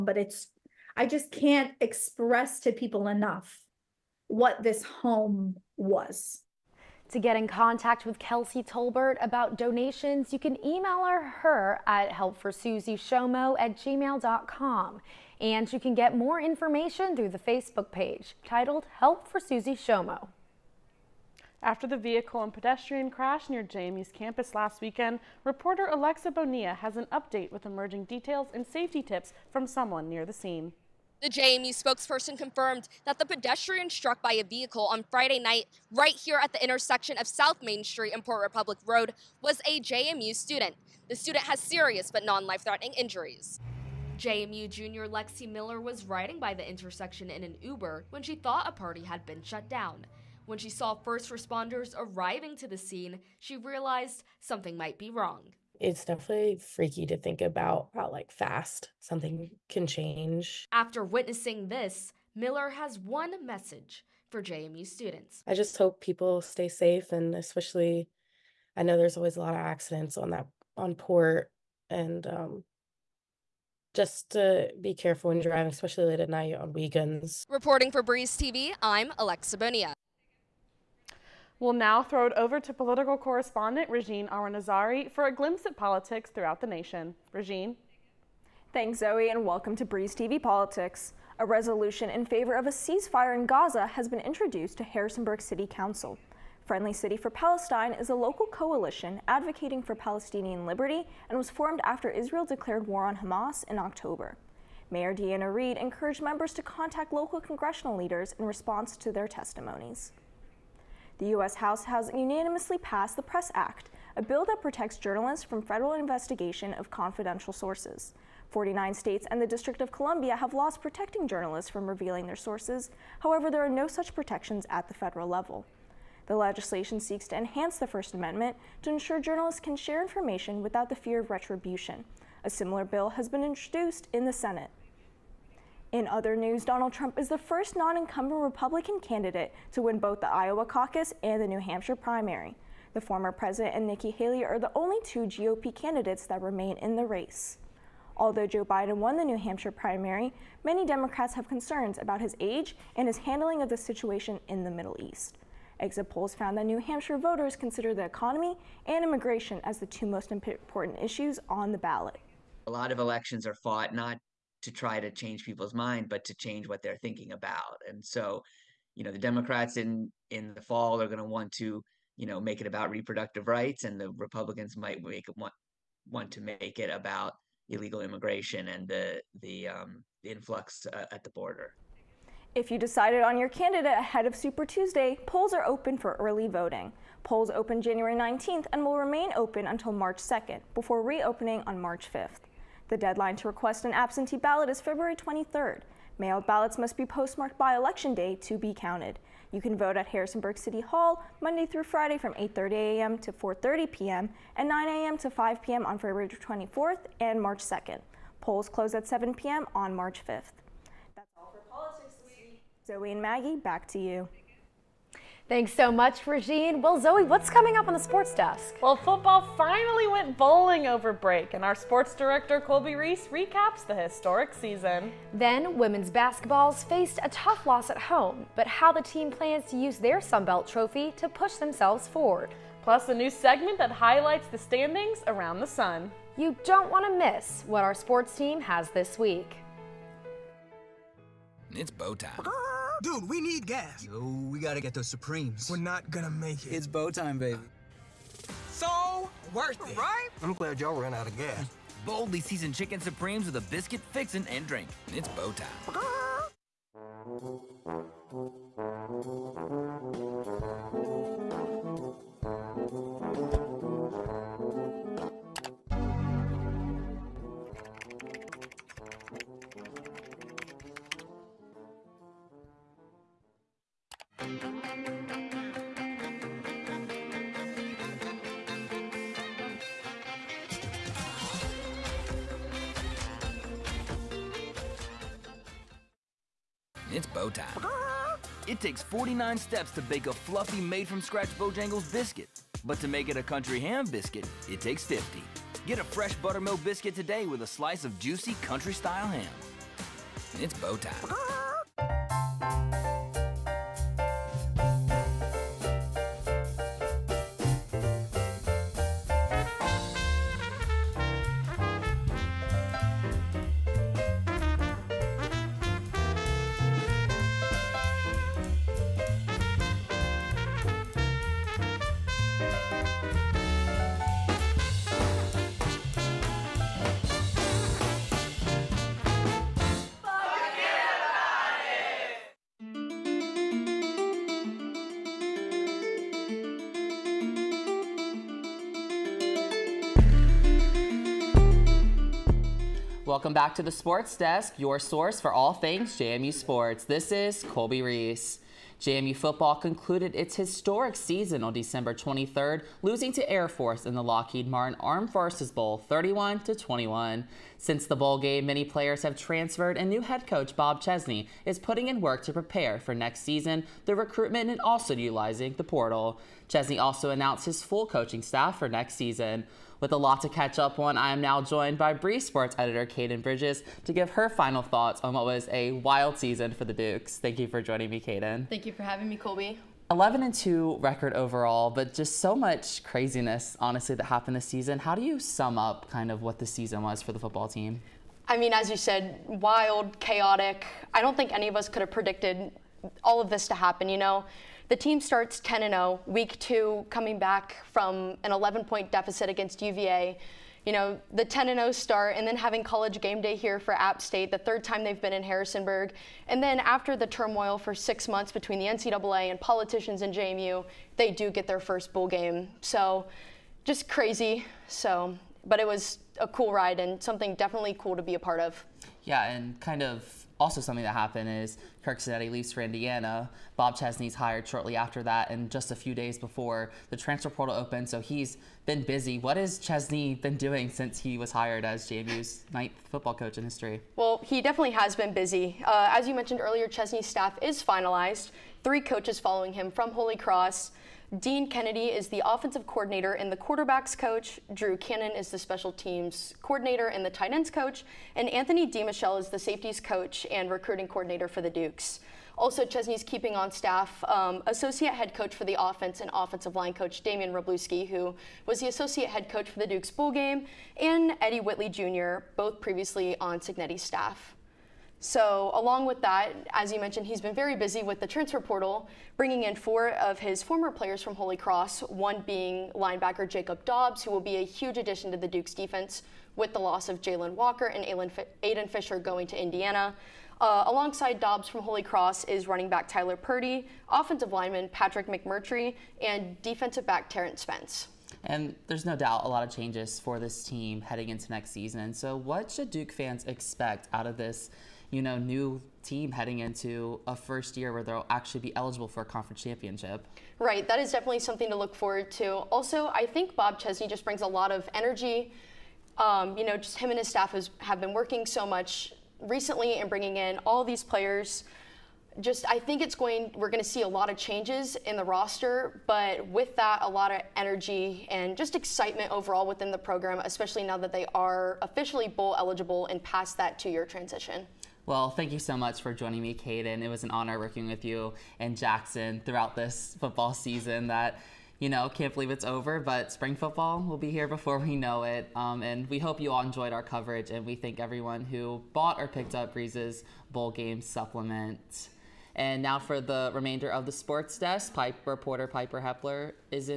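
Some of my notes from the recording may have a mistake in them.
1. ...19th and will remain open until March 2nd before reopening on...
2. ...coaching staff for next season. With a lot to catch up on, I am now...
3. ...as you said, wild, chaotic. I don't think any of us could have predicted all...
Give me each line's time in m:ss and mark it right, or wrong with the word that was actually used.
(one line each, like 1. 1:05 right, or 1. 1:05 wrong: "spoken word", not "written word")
1. 3:08 right
2. 6:08 right
3. 6:28 right.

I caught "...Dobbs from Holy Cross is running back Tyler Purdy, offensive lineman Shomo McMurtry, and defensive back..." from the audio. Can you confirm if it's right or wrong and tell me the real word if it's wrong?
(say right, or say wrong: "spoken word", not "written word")
wrong: "Patrick", not "Shomo".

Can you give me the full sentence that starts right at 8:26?
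Um, you know, just him and his staff has, have been working so much recently and bringing in all these players.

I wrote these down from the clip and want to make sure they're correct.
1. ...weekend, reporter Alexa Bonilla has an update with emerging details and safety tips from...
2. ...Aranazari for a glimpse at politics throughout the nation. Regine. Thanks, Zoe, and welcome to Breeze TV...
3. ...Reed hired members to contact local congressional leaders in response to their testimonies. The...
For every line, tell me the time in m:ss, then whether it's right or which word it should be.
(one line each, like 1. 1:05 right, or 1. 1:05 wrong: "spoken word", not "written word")
1. 0:24 right
2. 1:24 right
3. 1:45 wrong: "encouraged", not "hired".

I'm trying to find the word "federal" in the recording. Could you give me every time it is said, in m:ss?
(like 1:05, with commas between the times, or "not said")
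1:55, 2:04.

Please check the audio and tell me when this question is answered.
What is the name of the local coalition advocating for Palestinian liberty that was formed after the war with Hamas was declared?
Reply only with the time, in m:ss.
1:36.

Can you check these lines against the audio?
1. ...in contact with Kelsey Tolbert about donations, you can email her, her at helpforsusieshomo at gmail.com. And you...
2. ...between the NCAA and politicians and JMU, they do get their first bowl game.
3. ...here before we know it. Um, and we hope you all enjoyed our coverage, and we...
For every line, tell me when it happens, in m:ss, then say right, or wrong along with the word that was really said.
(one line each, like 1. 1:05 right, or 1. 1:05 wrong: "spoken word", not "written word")
1. 0:07 right
2. 6:48 right
3. 8:54 right.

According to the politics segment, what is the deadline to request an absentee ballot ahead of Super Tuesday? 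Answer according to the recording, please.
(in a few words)
February 23rd.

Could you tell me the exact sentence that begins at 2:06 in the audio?
The legislation seeks to enhance the First Amendment to ensure journalists can share information without the fear of retribution.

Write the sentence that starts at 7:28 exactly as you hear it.
And Anthony DeMichelle is the safeties coach and recruiting coordinator for the Dukes.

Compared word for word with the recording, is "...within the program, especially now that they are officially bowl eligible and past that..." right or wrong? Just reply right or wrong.
right.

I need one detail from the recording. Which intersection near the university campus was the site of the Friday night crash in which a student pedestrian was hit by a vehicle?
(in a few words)
South Main Street and Port Republic Road.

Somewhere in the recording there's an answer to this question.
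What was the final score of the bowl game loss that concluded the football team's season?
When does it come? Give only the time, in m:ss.
5:56.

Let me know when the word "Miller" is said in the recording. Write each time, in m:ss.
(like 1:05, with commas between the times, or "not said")
0:45, 1:02.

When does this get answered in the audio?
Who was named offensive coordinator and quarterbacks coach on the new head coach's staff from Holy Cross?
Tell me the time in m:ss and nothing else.
7:21.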